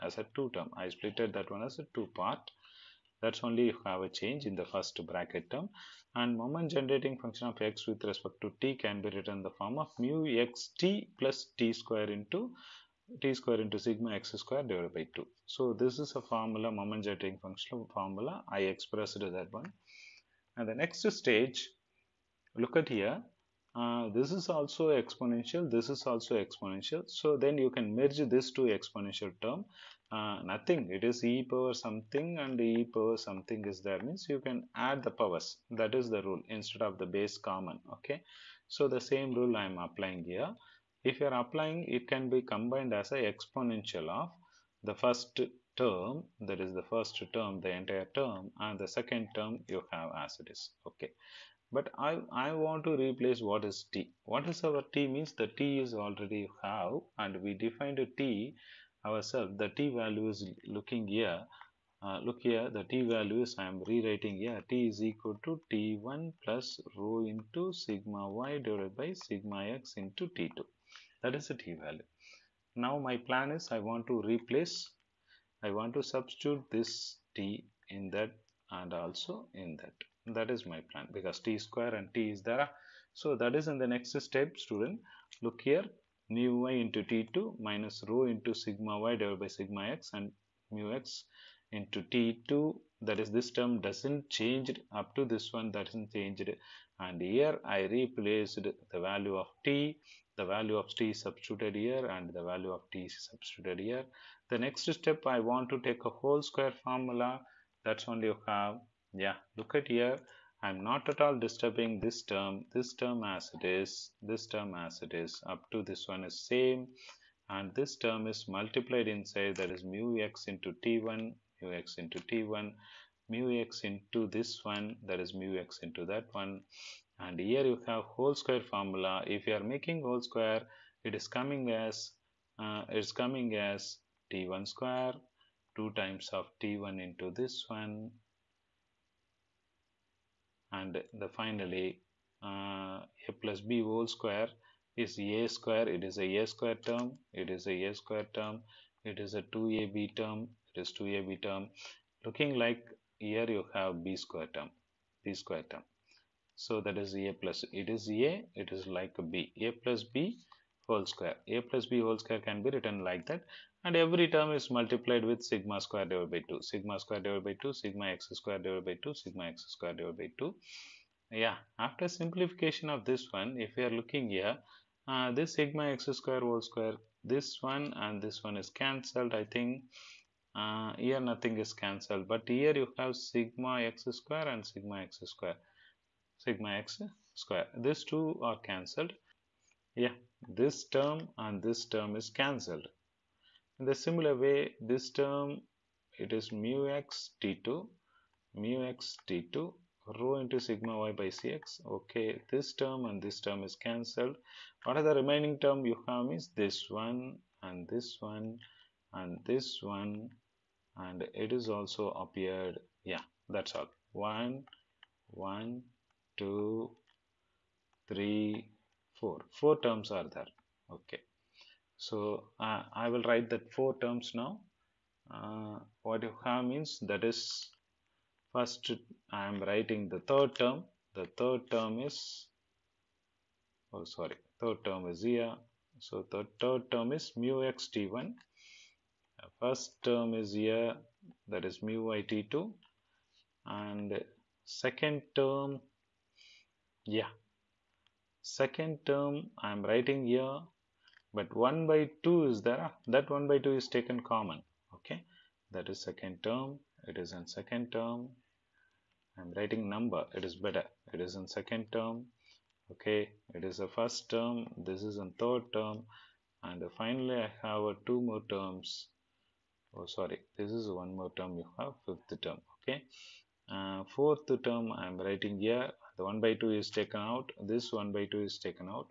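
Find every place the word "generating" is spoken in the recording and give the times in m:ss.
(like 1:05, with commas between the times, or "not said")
0:06, 0:17.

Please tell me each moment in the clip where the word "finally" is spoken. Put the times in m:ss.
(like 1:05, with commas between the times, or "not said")
2:21, 4:26.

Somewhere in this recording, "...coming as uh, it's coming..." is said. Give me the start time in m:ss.
2:11.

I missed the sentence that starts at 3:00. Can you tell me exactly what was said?
Uh, here nothing is cancelled, but here you have sigma x square and sigma x square, sigma x square.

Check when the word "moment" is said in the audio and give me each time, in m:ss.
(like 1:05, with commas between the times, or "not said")
0:06, 0:16.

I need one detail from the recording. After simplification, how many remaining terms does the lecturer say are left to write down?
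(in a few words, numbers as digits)
4.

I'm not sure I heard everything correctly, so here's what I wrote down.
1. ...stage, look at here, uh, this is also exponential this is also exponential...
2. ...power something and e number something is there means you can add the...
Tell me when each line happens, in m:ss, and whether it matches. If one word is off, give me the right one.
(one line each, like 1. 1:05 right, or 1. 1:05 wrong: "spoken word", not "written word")
1. 0:21 right
2. 0:31 wrong: "power", not "number".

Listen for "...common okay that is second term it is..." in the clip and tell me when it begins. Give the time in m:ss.
4:14.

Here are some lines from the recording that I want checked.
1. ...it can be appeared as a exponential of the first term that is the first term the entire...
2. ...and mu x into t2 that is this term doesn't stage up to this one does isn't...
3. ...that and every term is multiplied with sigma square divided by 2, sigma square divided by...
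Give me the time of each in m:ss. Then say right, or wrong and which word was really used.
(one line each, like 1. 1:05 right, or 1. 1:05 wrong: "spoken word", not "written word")
1. 0:41 wrong: "combined", not "appeared"
2. 1:30 wrong: "change", not "stage"
3. 2:43 right.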